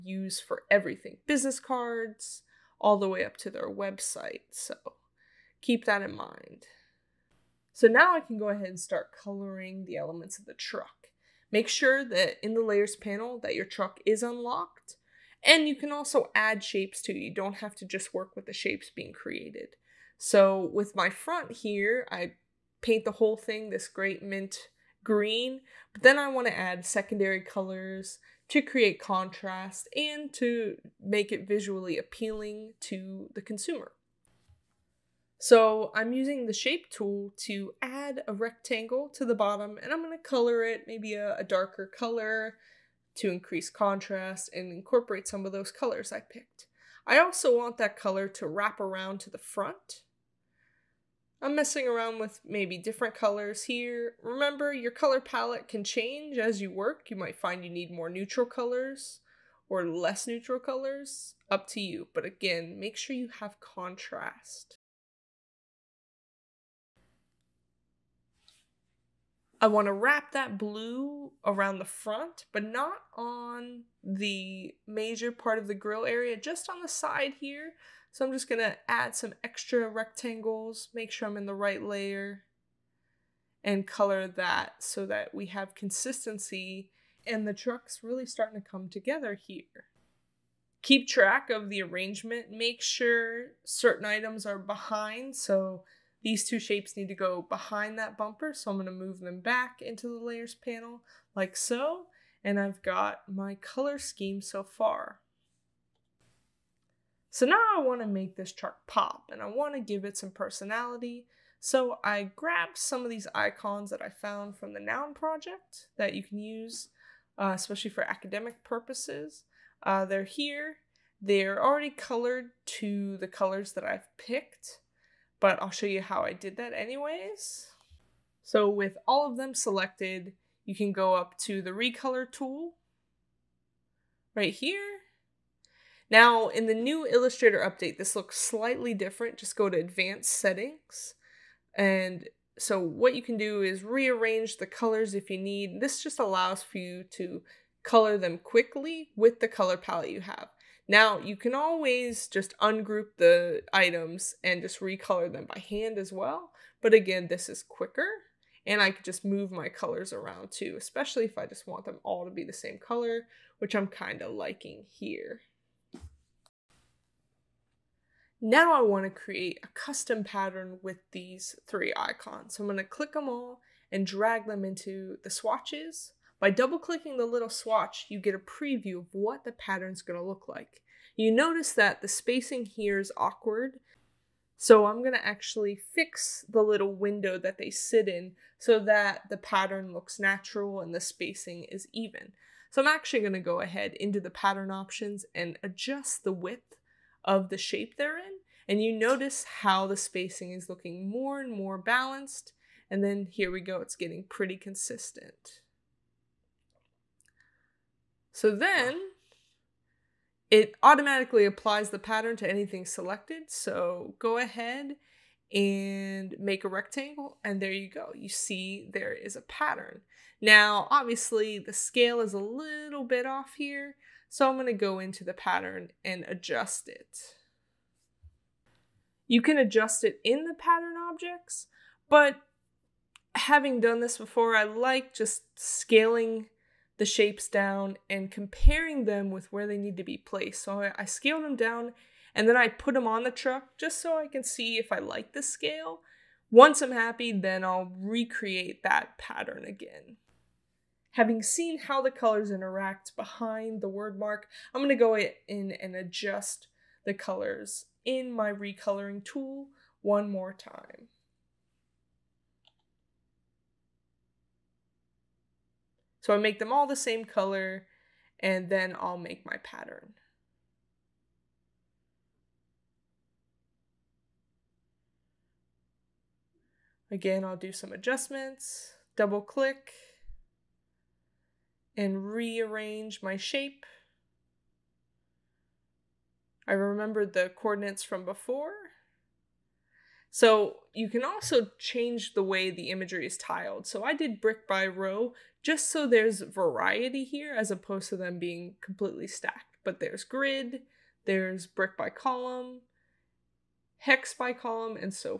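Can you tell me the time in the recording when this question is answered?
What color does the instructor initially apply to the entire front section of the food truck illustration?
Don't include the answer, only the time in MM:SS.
00:24.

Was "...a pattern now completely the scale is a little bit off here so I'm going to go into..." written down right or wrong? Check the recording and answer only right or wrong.
wrong.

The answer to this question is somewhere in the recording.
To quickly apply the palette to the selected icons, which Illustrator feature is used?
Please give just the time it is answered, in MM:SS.
02:11.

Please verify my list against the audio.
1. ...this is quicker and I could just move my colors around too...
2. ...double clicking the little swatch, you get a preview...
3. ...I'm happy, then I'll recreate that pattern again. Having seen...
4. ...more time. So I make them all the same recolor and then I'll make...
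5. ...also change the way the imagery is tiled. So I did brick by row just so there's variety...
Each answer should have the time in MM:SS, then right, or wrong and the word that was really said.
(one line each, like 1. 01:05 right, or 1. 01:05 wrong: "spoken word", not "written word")
1. 02:37 right
2. 02:56 right
3. 04:06 right
4. 04:20 wrong: "color", not "recolor"
5. 04:51 right.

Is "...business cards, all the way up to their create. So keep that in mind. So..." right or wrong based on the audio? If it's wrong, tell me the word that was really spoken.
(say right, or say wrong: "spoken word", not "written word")
wrong: "website", not "create".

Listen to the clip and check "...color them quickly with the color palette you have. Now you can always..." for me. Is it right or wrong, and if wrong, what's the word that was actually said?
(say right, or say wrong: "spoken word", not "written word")
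right.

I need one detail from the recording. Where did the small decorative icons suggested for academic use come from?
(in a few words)
Noun Project.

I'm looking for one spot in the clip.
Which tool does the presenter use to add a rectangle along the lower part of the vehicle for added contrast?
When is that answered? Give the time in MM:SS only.
00:36.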